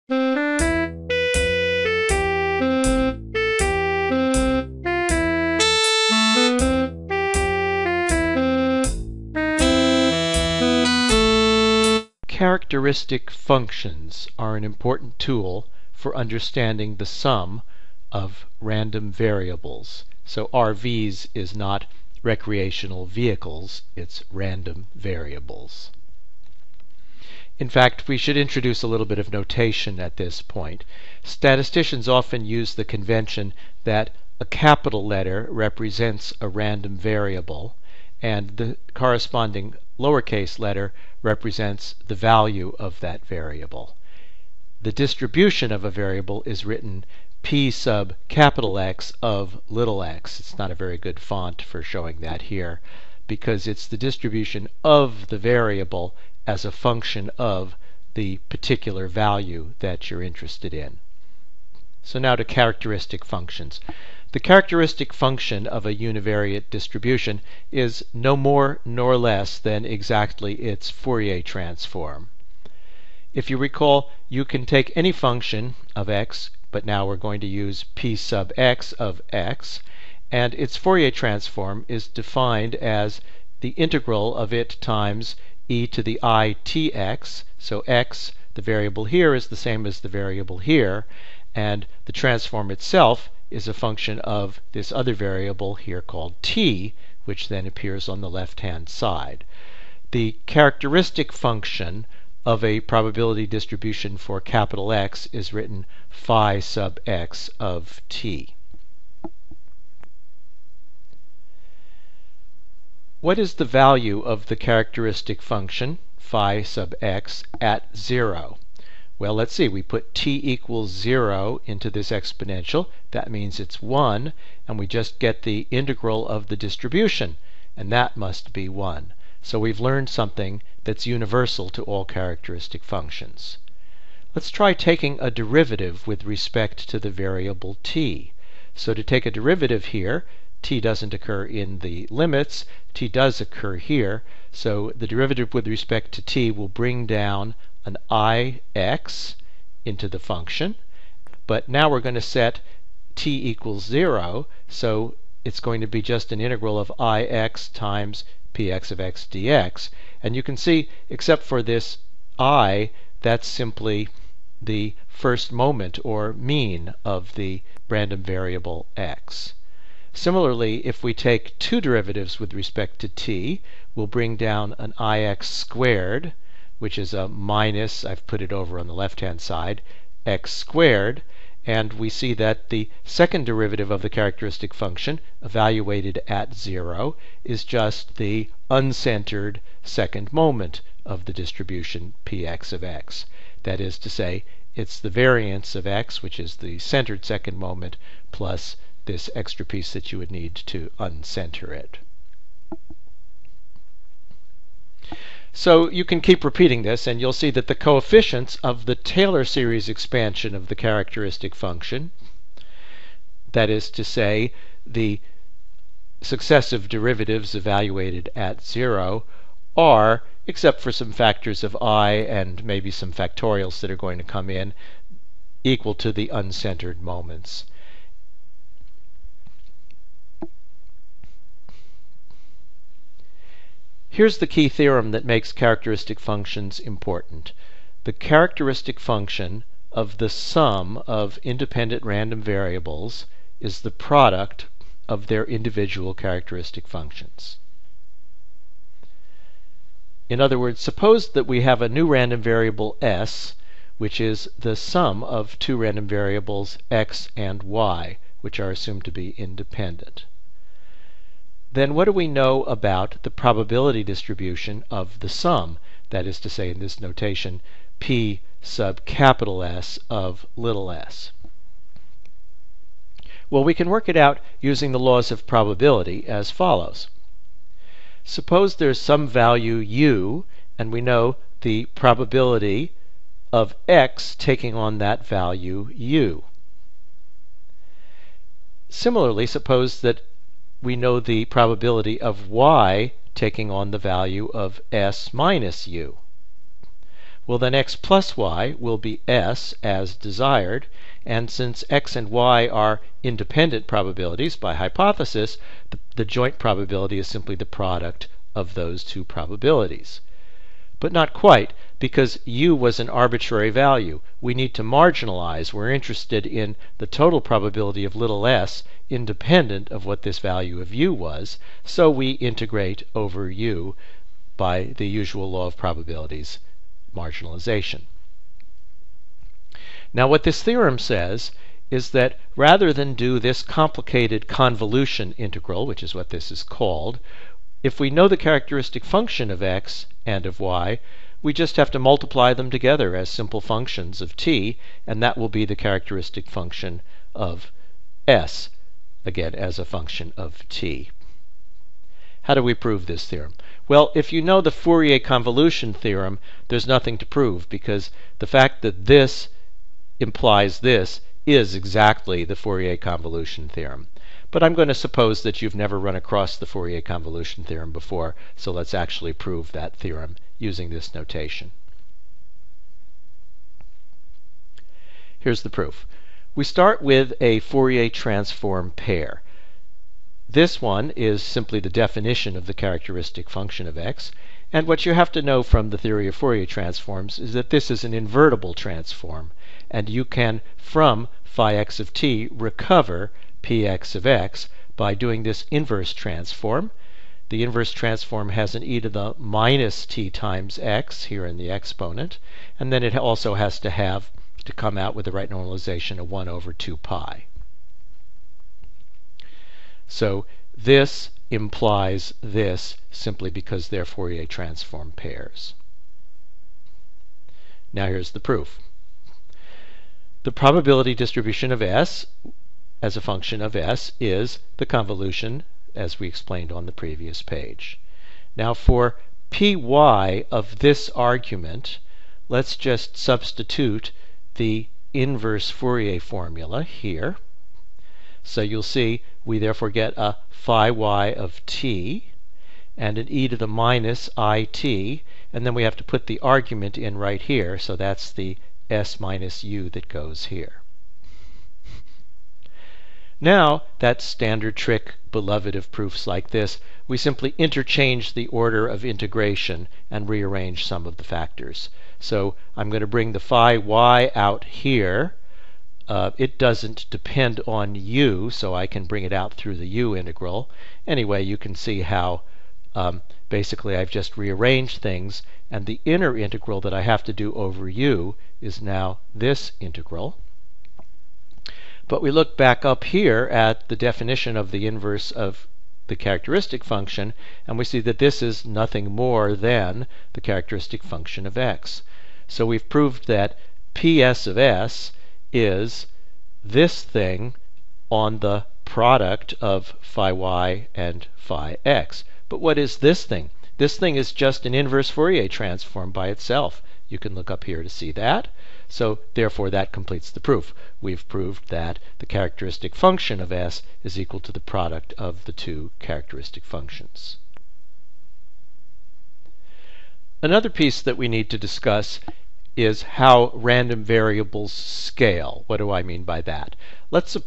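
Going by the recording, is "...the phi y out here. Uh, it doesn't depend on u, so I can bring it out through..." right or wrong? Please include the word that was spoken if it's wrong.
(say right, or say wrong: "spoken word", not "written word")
right.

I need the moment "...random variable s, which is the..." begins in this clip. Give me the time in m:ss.
4:12.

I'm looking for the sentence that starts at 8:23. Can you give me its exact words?
This thing is just an inverse Fourier transform by itself.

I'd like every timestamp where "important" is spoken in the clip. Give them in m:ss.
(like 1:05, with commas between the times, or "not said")
0:14, 3:56.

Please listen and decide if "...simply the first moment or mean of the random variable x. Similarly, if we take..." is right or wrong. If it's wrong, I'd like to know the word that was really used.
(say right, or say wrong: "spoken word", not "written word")
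right.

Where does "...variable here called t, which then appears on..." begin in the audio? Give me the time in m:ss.
1:35.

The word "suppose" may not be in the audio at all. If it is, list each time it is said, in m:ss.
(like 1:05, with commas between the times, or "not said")
4:10, 4:38, 4:49, 6:04.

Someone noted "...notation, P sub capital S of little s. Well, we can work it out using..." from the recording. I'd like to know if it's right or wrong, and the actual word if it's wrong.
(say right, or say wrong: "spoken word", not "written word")
right.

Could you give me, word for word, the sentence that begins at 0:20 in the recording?
So RVs is not recreational vehicles, it's random variables.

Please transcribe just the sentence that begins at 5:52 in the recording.
How do we prove this theorem?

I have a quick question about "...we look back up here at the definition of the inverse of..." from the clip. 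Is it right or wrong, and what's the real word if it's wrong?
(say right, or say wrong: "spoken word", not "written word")
right.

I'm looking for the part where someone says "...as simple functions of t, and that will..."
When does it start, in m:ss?
5:43.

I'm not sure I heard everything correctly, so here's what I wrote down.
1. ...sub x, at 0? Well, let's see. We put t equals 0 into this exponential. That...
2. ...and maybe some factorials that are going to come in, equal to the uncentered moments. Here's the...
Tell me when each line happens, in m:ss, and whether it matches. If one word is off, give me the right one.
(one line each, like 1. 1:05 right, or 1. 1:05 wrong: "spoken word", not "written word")
1. 1:56 right
2. 3:42 right.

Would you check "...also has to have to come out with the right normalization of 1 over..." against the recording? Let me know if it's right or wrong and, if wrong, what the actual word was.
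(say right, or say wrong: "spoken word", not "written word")
right.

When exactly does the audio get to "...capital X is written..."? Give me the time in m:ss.
1:44.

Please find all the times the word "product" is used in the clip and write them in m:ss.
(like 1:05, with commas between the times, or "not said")
4:03, 5:07, 8:18, 8:34.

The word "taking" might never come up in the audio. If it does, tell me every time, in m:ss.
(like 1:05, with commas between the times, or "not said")
2:14, 4:44, 4:53.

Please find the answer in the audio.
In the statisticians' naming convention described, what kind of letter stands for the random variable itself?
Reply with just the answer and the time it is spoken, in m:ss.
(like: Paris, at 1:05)
capital letter, at 0:34.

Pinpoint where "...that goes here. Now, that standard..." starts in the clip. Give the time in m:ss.
7:29.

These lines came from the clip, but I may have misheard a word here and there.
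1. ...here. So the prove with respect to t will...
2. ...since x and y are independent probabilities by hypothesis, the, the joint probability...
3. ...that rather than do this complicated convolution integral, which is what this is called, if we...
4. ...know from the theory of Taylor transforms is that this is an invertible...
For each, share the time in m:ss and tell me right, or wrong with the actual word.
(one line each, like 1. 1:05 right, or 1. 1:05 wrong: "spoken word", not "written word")
1. 2:23 wrong: "derivative", not "prove"
2. 5:01 right
3. 5:32 right
4. 6:25 wrong: "Fourier", not "Taylor".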